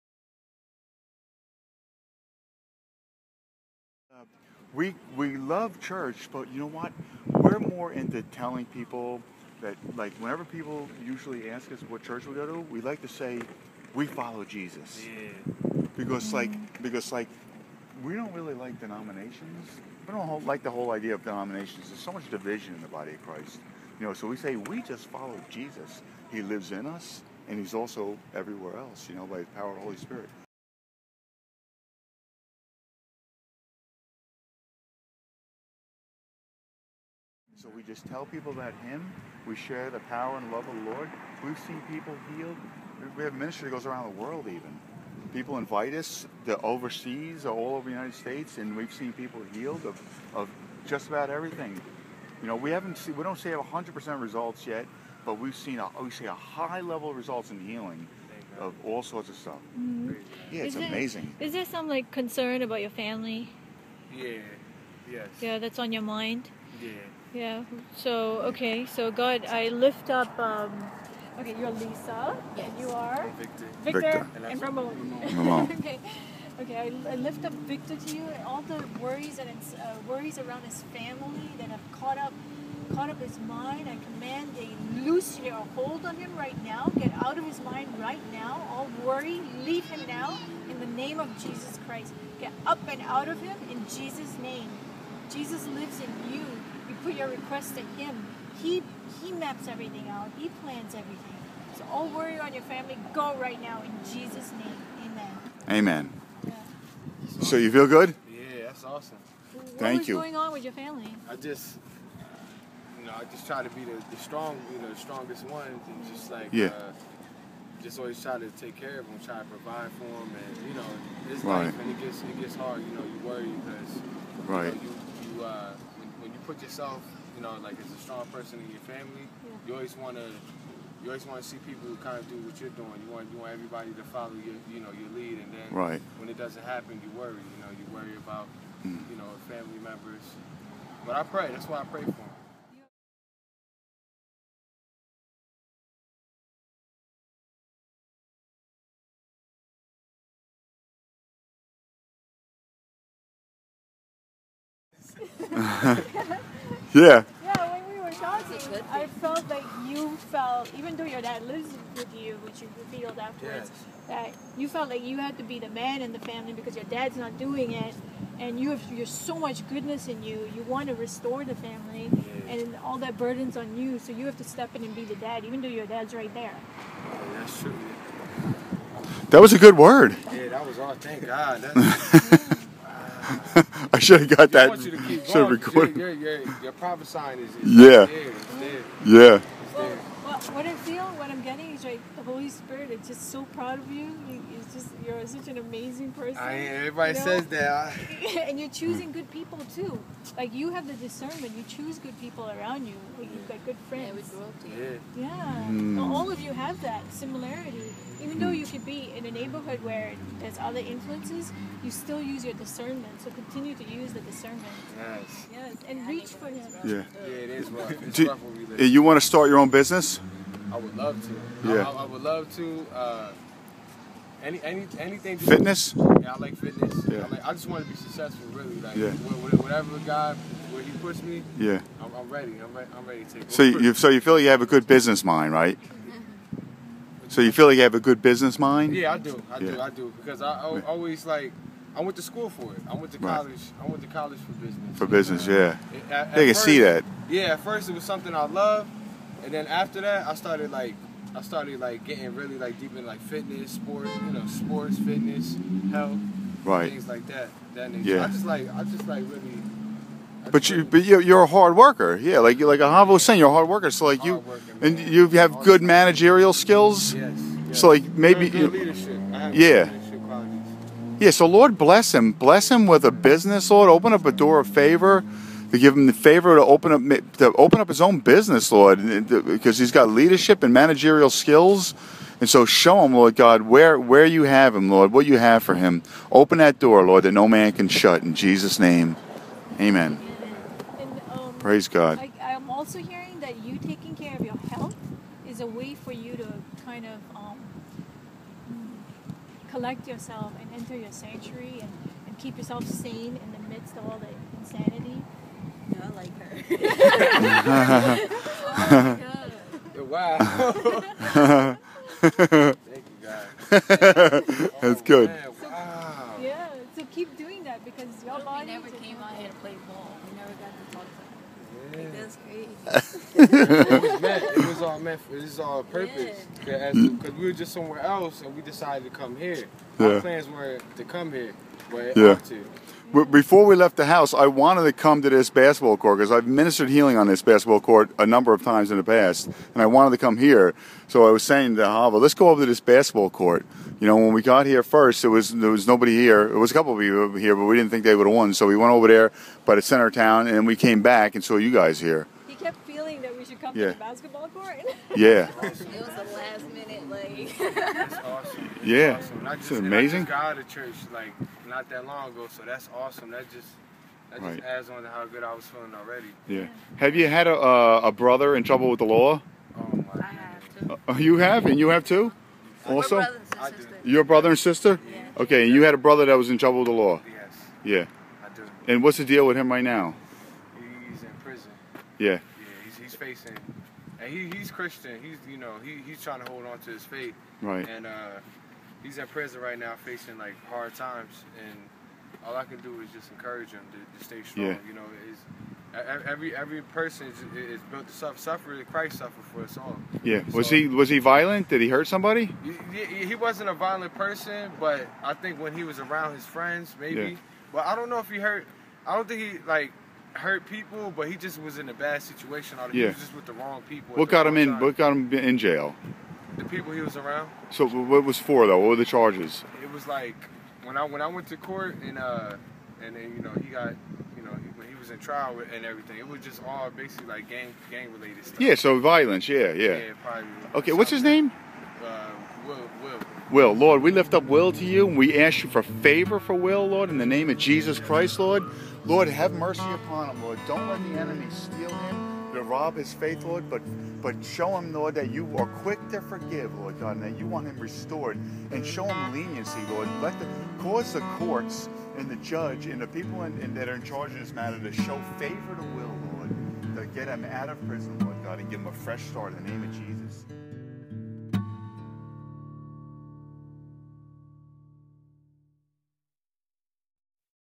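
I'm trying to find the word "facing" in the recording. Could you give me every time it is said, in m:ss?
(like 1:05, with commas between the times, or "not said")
6:23, 6:30.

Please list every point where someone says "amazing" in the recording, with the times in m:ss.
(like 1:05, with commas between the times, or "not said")
1:00, 3:15, 5:59.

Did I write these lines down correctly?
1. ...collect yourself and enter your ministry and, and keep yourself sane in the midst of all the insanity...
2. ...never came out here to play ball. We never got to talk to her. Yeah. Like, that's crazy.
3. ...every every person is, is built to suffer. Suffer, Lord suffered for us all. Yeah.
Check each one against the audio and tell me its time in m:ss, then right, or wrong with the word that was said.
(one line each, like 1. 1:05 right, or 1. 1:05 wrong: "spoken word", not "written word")
1. 4:59 wrong: "sanctuary", not "ministry"
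2. 5:18 right
3. 6:36 wrong: "Christ", not "Lord".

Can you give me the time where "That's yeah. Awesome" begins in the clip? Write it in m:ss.
5:58.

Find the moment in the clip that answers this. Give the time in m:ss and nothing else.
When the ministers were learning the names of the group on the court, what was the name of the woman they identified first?
1:11.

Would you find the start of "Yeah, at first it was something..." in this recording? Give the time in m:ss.
4:07.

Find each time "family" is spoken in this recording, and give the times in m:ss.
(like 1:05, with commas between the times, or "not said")
1:02, 1:20, 1:42, 1:50, 2:08, 2:19, 2:46, 2:51.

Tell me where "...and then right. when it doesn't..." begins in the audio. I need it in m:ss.
2:15.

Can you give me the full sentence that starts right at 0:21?
There's so much division in the body of Christ.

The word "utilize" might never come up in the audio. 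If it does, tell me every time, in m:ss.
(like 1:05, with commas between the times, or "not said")
not said.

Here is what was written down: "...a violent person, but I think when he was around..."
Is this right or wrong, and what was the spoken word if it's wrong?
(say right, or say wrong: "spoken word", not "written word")
right.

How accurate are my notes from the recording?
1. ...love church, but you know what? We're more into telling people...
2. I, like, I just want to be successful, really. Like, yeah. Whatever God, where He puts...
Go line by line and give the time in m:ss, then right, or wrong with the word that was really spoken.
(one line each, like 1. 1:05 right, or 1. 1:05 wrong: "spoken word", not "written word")
1. 0:05 right
2. 3:47 right.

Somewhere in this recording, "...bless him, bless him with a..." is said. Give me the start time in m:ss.
4:31.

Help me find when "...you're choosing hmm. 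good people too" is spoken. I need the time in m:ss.
3:18.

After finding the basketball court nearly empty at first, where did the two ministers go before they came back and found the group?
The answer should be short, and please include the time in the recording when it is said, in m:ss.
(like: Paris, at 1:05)
The center of town, at 5:49.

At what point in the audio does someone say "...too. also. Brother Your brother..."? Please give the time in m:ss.
6:12.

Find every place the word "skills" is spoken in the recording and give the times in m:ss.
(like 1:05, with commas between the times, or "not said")
4:26, 4:41.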